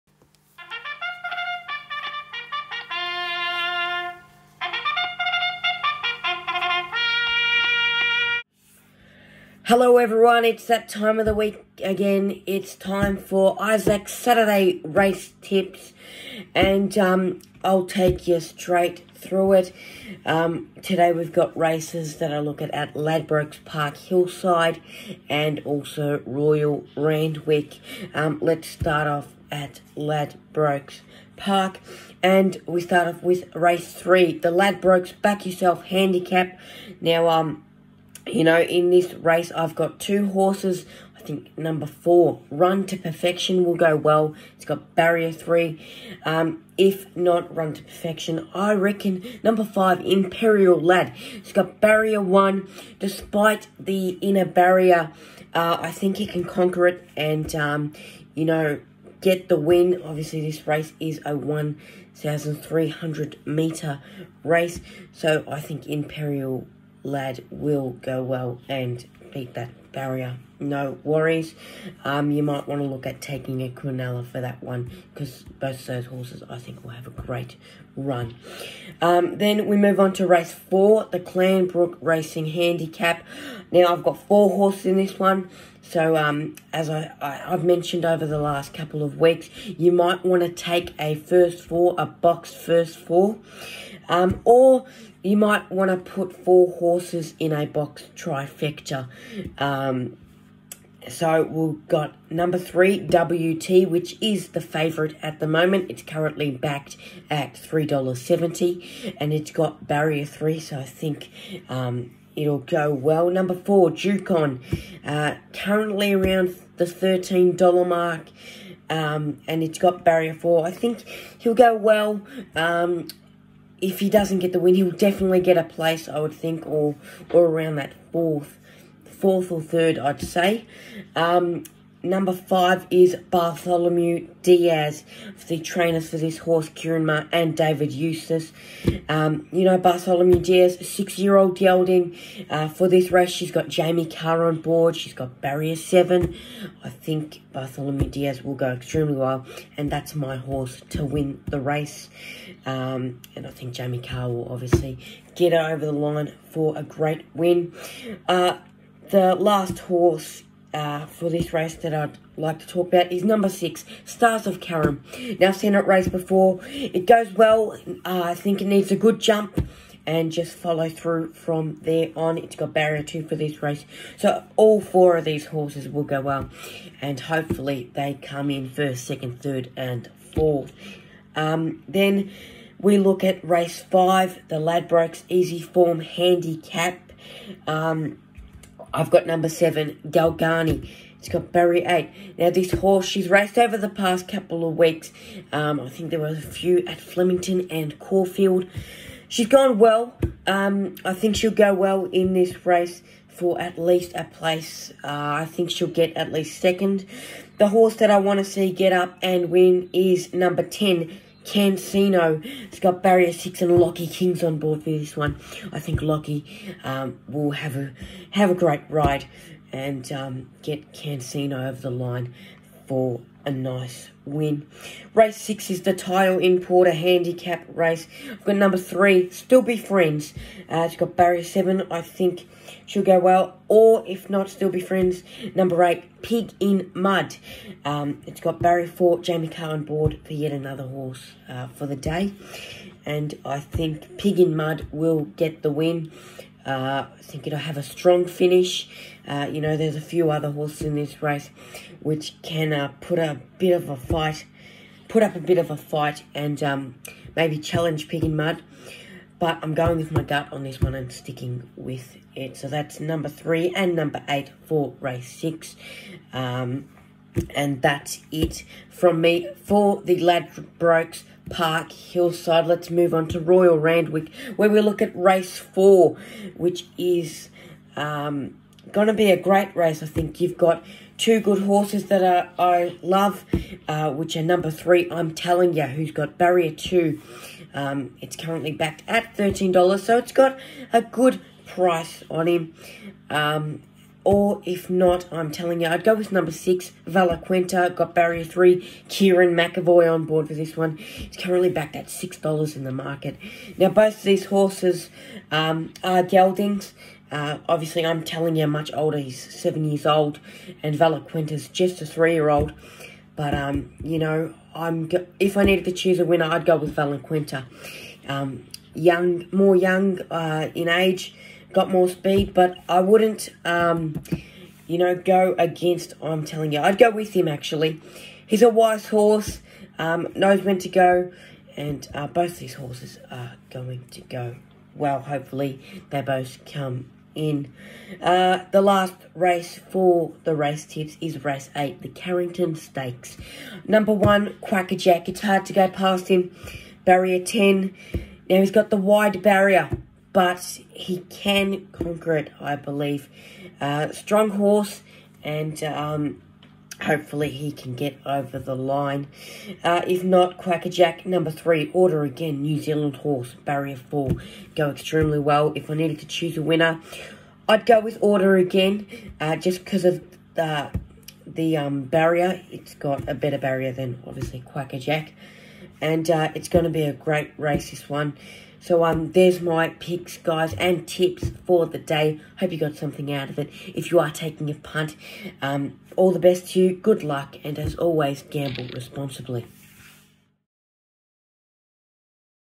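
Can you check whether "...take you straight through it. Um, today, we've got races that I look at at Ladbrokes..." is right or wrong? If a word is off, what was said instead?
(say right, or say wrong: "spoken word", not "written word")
right.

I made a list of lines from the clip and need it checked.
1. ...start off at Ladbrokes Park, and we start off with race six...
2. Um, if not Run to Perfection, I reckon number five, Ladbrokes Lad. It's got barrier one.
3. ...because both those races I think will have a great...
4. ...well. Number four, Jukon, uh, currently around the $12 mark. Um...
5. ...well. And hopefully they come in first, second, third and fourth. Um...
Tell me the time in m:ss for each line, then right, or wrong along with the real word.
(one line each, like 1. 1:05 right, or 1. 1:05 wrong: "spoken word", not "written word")
1. 0:28 wrong: "three", not "six"
2. 0:46 wrong: "Imperial", not "Ladbrokes"
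3. 1:15 wrong: "horses", not "races"
4. 1:52 wrong: "13", not "12"
5. 2:56 right.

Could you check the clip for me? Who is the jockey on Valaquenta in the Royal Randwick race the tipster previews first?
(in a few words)
Kerrin McEvoy.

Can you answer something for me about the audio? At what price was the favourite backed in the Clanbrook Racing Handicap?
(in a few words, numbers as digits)
$3.70.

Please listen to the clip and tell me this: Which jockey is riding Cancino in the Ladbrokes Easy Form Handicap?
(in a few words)
Lockie Kings.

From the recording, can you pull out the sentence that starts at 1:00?
Obviously, this race is a 1,300 meter race, so I think Imperial lad will go well and beat that barrier no worries.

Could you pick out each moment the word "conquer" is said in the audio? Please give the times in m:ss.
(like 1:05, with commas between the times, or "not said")
0:56, 5:51.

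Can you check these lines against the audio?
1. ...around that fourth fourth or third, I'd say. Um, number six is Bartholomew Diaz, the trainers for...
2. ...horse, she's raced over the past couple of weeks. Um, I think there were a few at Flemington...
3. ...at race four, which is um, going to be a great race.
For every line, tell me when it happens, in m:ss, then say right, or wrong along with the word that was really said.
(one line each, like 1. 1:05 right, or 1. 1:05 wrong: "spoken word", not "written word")
1. 2:07 wrong: "five", not "six"
2. 3:12 right
3. 4:35 right.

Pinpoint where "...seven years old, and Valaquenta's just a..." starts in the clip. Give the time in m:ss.
5:09.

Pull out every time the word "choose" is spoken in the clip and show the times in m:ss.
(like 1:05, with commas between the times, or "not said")
5:15, 6:06.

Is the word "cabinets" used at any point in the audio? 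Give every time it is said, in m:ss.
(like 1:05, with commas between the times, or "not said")
not said.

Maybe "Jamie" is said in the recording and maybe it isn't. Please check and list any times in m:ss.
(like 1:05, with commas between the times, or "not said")
2:23, 2:33, 3:59.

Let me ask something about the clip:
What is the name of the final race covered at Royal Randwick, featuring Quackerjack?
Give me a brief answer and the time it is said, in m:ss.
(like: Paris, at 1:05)
Carrington Stakes, at 5:42.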